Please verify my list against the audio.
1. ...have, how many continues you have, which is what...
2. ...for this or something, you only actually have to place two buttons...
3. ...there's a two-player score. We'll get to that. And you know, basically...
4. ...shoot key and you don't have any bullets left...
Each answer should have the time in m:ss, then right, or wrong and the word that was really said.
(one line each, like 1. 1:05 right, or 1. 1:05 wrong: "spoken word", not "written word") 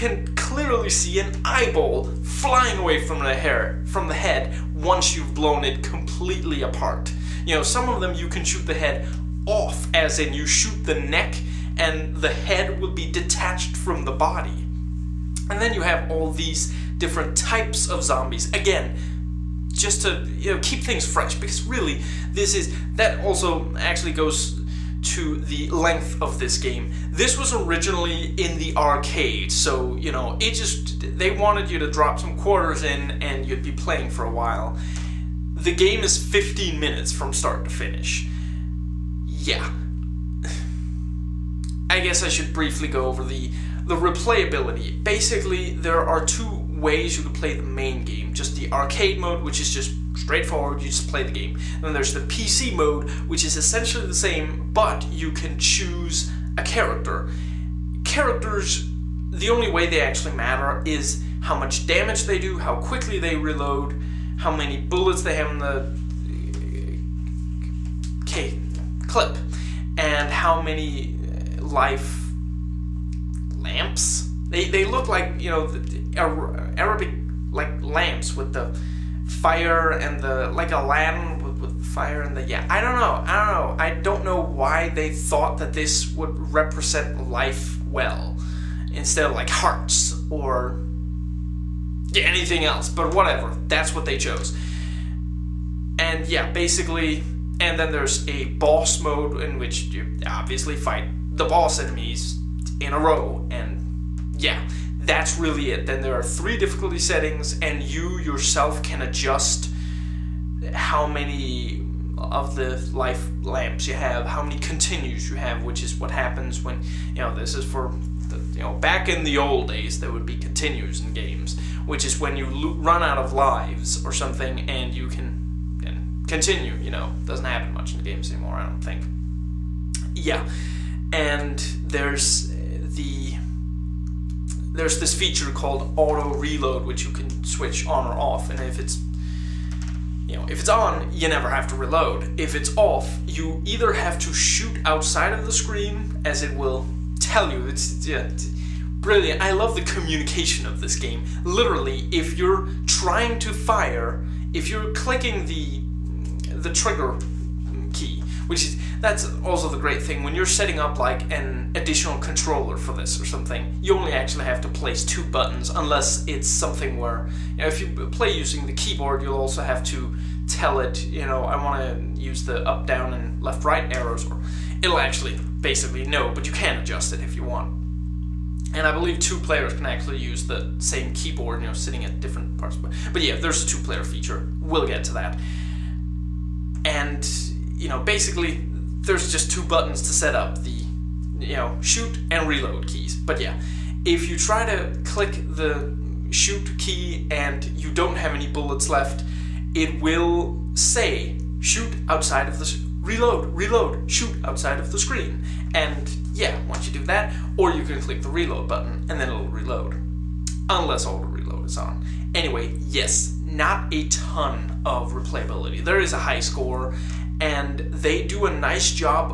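1. 1:53 right
2. 2:42 right
3. 3:03 wrong: "feature", not "score"
4. 3:16 right.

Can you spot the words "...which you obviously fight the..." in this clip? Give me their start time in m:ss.
1:39.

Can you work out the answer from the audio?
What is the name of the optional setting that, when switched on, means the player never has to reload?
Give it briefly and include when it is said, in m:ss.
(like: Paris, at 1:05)
Auto reload, at 2:15.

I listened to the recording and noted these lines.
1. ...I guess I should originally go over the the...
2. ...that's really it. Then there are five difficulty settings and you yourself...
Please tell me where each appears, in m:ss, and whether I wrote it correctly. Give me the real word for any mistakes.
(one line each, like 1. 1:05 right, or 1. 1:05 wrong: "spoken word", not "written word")
1. 0:41 wrong: "briefly", not "originally"
2. 1:44 wrong: "three", not "five".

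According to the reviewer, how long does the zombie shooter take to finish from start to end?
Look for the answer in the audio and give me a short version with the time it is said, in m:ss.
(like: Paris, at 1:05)
15 minutes, at 0:36.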